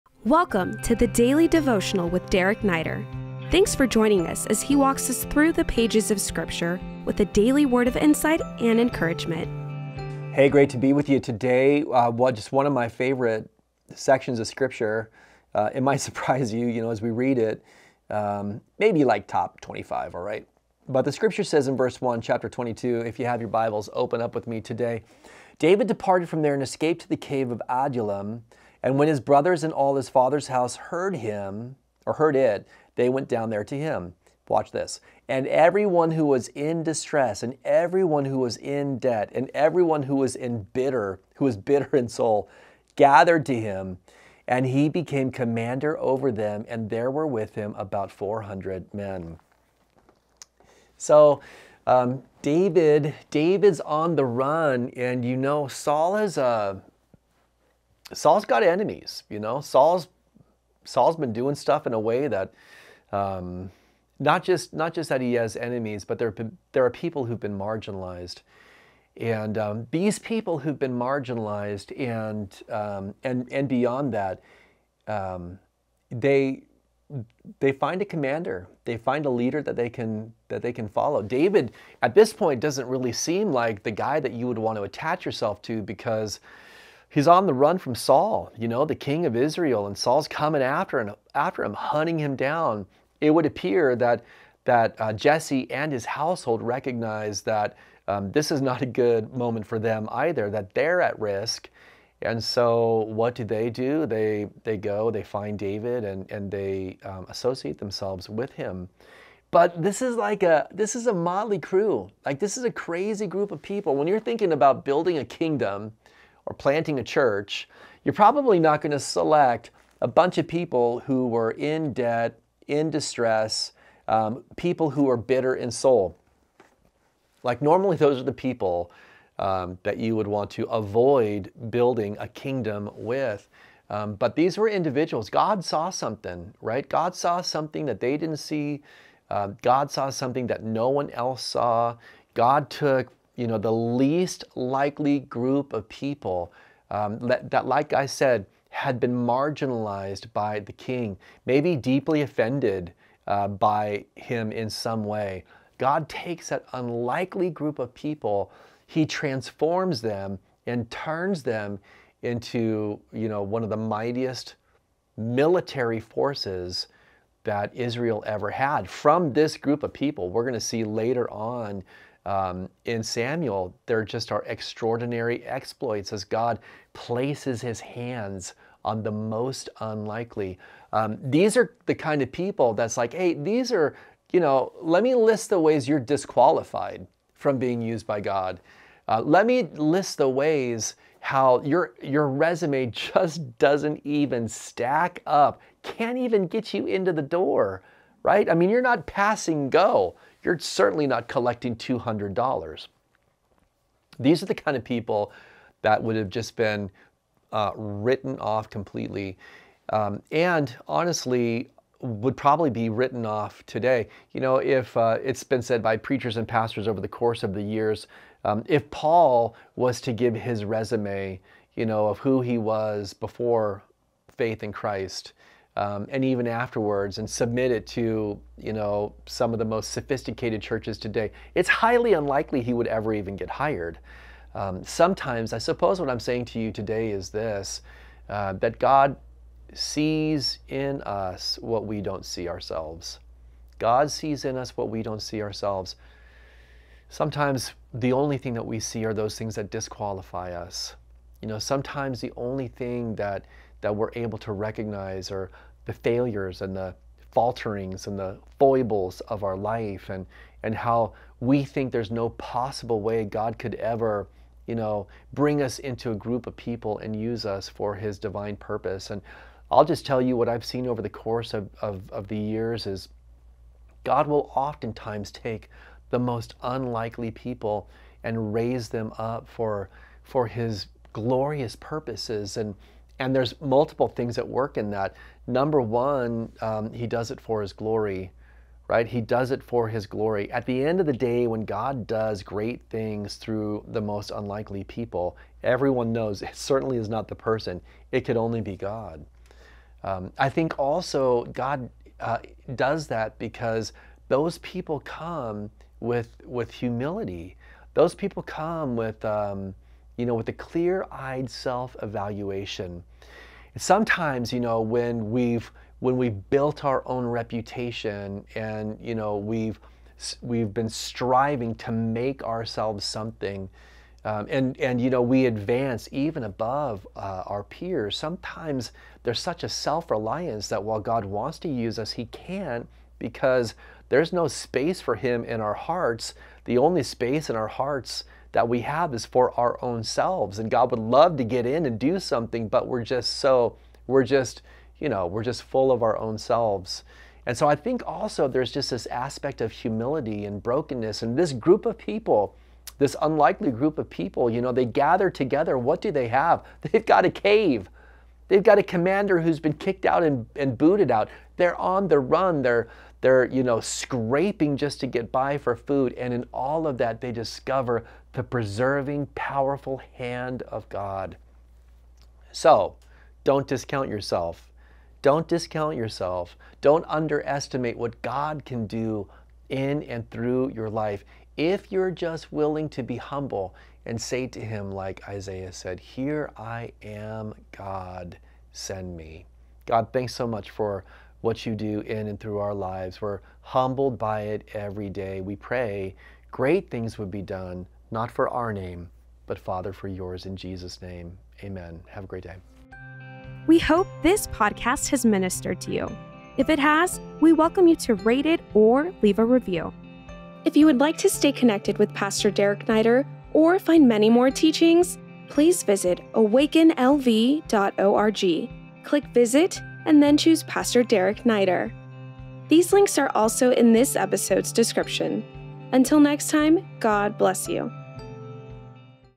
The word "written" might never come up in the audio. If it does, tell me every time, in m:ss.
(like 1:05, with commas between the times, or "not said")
3:27, 3:32.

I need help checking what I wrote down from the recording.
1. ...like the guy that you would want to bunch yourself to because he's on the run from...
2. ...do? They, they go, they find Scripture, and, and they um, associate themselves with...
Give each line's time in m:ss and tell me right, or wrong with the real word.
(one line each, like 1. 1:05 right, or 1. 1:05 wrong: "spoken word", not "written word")
1. 1:23 wrong: "attach", not "bunch"
2. 1:43 wrong: "David", not "Scripture".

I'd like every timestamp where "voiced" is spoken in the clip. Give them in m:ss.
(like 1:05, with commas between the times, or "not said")
not said.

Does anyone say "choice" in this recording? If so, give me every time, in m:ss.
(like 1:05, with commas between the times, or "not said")
not said.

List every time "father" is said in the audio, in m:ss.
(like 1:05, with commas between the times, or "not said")
0:30, 6:39.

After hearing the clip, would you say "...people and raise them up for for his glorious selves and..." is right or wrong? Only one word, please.
wrong.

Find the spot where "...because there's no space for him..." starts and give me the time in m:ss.
5:33.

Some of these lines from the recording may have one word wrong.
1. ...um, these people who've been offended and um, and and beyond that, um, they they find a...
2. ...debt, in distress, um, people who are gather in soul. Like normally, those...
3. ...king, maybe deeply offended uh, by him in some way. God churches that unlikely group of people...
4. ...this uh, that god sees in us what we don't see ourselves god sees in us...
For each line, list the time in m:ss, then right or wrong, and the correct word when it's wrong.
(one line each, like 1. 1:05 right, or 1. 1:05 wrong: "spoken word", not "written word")
1. 1:09 wrong: "marginalized", not "offended"
2. 2:01 wrong: "bitter", not "gather"
3. 2:30 wrong: "takes", not "churches"
4. 3:57 right.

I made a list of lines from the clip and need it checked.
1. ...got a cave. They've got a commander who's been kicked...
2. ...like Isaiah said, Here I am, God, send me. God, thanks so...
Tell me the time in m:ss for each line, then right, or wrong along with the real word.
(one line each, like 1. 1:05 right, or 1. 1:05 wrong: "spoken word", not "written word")
1. 5:57 right
2. 6:24 right.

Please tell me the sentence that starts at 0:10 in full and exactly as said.
Hey, great to be with you today.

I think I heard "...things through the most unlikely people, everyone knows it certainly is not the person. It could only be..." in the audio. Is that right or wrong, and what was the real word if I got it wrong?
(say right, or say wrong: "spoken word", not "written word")
right.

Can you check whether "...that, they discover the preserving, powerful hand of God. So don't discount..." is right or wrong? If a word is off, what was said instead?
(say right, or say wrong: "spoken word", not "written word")
right.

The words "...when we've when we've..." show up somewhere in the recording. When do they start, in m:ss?
5:14.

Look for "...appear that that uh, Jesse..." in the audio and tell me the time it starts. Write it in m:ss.
1:33.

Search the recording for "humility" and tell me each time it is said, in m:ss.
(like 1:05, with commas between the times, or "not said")
5:06, 5:49.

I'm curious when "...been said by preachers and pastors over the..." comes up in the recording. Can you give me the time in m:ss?
3:35.